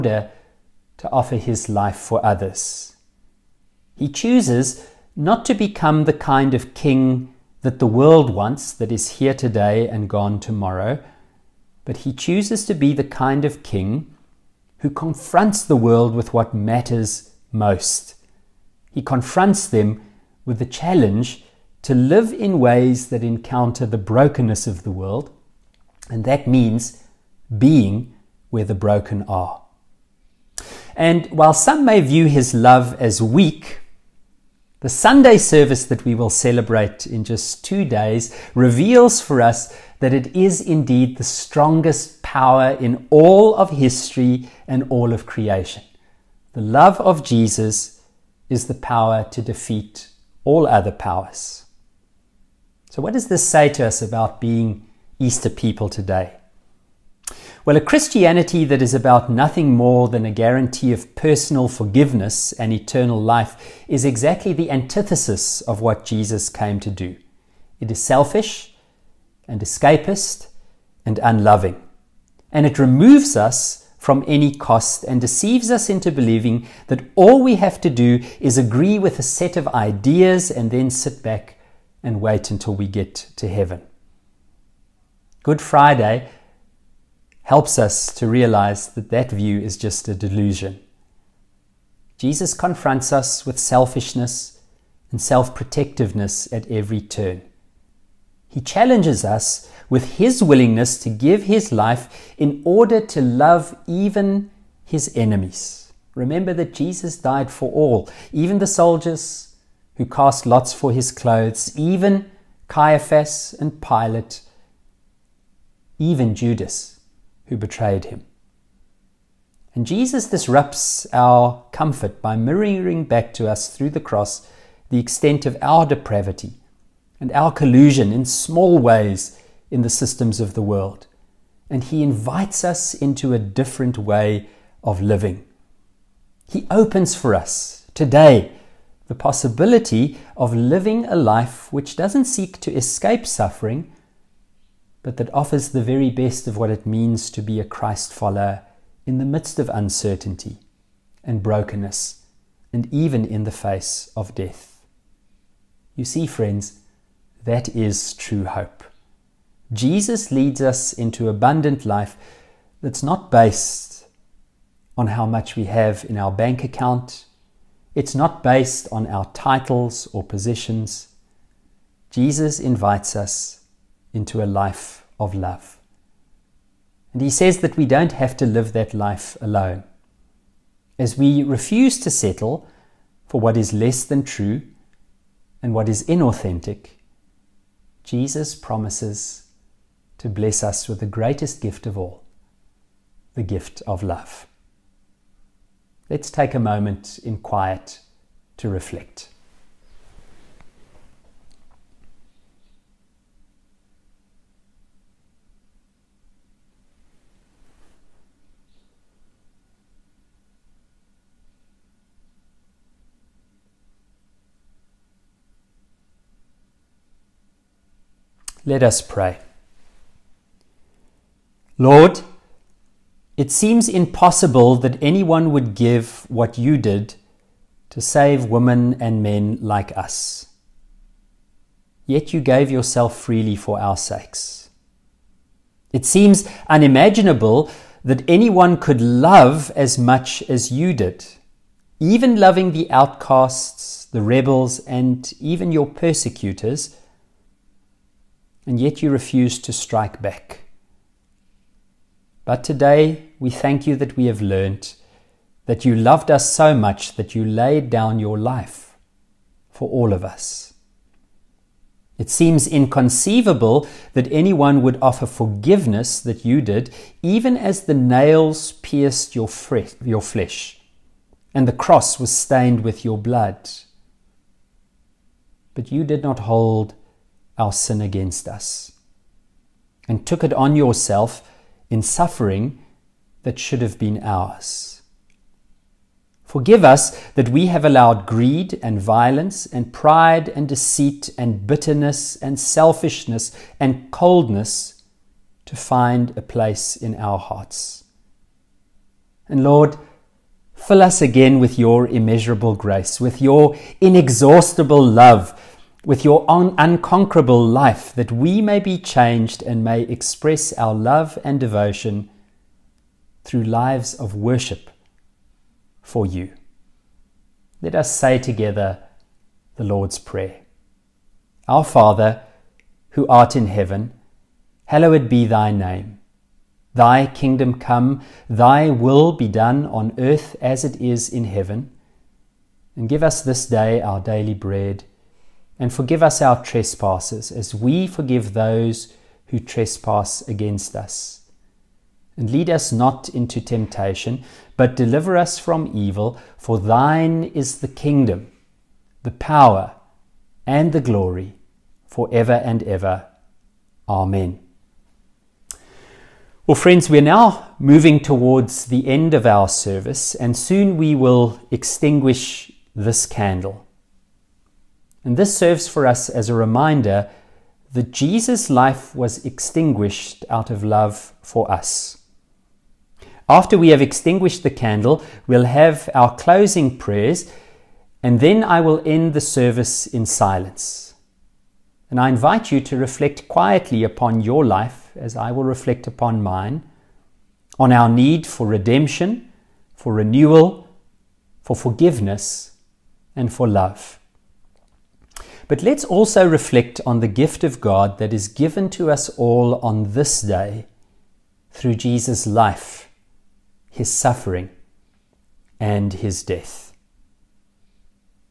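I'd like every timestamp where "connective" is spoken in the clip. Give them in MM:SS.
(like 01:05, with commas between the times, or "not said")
not said.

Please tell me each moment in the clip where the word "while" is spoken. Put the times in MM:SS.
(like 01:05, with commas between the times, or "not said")
00:31.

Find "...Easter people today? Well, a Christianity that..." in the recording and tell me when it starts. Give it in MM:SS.
00:55.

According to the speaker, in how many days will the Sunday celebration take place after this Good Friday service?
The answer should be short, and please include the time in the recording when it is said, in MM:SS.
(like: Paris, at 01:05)
2, at 00:37.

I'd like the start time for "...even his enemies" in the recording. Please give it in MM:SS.
01:43.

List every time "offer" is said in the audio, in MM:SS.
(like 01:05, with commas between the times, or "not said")
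00:01, 02:25, 04:25.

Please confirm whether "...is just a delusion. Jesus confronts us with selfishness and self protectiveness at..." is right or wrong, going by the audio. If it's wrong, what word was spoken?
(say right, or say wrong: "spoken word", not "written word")
right.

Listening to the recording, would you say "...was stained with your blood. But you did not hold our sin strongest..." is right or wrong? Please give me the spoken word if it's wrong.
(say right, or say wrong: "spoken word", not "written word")
wrong: "against", not "strongest".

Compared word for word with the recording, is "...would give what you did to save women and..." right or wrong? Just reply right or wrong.
right.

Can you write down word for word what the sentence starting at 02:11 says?
And he invites us into a different way of living.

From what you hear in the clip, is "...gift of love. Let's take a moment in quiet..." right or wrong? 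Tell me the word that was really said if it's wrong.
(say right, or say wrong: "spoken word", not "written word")
right.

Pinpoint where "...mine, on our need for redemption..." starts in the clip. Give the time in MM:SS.
06:26.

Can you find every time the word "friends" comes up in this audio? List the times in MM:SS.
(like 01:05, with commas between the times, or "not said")
02:36, 05:56.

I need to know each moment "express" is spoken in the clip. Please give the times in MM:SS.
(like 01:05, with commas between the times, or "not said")
05:10.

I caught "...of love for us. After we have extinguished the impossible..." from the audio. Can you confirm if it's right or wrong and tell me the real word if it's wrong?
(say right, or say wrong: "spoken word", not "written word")
wrong: "candle", not "impossible".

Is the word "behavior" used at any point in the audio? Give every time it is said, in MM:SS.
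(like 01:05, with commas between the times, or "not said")
not said.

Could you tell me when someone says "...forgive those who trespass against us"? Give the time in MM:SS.
05:38.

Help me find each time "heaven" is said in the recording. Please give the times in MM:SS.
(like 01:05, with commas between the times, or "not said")
01:23, 05:23, 05:31.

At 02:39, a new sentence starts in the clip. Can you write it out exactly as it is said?
Jesus leads us into abundant life that's not based on how much we have in our bank account.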